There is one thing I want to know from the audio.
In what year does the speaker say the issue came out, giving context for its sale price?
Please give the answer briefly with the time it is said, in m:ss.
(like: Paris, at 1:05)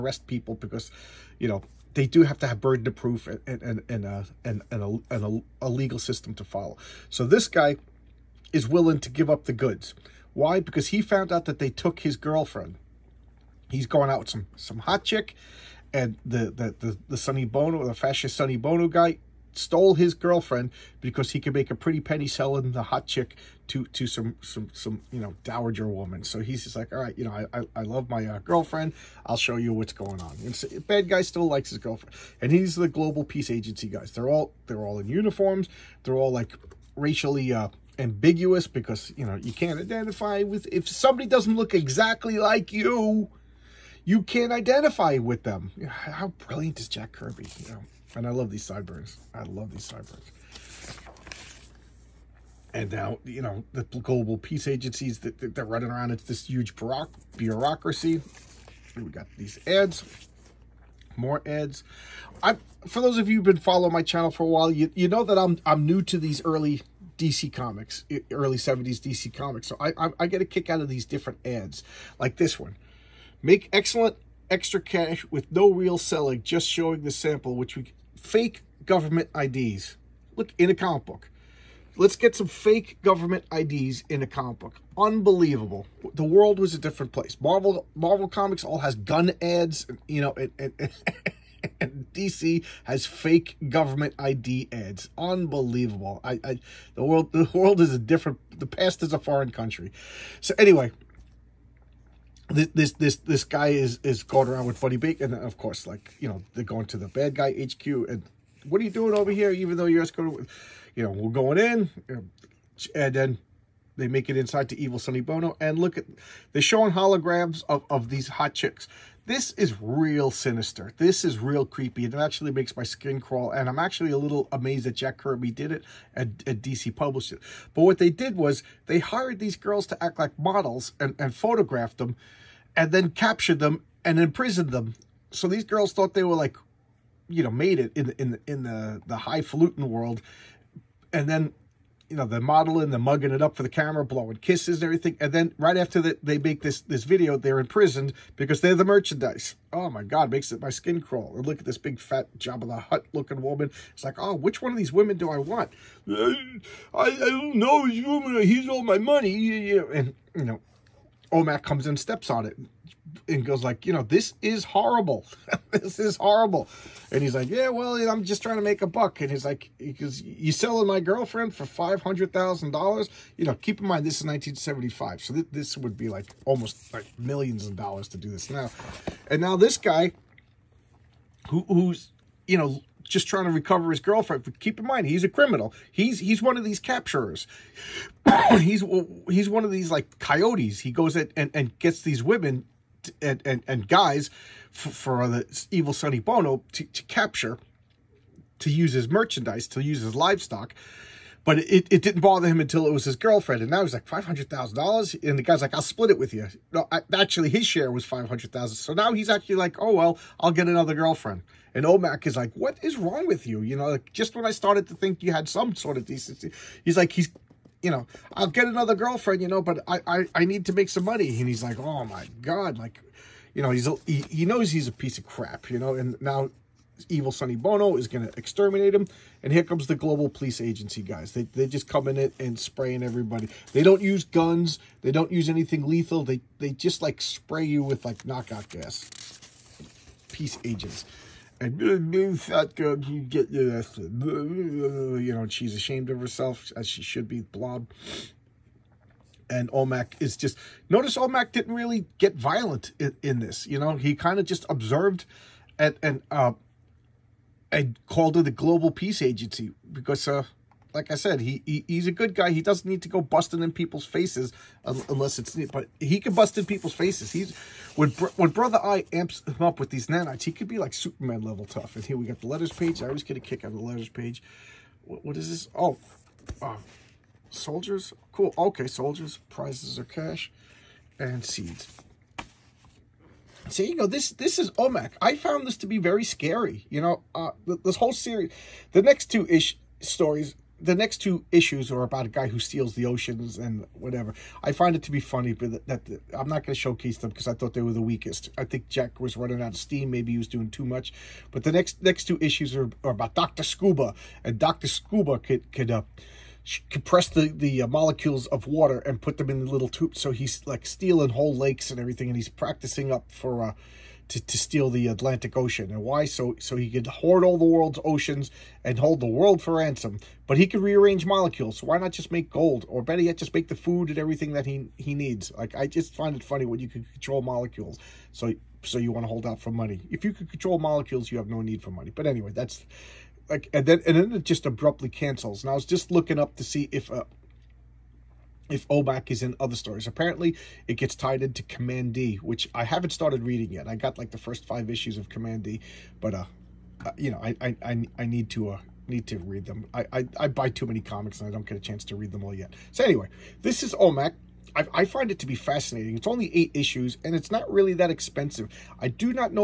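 1975, at 2:54.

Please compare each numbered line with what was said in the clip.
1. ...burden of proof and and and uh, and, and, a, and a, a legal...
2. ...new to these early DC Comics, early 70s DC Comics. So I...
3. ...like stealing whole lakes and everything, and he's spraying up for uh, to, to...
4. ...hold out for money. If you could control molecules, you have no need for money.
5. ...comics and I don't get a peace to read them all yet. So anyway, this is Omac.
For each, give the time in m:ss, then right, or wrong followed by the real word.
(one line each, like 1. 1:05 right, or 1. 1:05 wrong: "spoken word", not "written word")
1. 0:02 right
2. 1:05 right
3. 5:10 wrong: "practicing", not "spraying"
4. 5:29 right
5. 5:50 wrong: "chance", not "peace".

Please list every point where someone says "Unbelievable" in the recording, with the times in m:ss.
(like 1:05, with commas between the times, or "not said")
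1:24, 1:35.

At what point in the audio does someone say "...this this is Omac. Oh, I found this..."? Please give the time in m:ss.
4:44.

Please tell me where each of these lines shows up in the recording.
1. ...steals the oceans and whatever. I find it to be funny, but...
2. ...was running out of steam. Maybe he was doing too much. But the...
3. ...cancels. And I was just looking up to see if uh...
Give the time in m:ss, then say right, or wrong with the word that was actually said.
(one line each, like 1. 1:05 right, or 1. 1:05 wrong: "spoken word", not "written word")
1. 4:52 right
2. 4:59 right
3. 5:35 right.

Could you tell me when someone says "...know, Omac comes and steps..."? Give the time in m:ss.
2:40.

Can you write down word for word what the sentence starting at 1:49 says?
Even though you're just going, you know, we're going in, and then they make it inside to Evil Sonny Bono.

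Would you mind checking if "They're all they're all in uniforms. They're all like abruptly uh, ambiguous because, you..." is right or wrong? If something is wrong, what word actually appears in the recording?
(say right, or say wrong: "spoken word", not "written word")
wrong: "racially", not "abruptly".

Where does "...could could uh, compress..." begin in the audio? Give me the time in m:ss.
5:05.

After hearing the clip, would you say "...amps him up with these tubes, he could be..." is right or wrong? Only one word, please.
wrong.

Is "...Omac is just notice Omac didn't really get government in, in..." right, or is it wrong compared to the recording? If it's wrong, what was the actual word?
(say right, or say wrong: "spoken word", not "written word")
wrong: "violent", not "government".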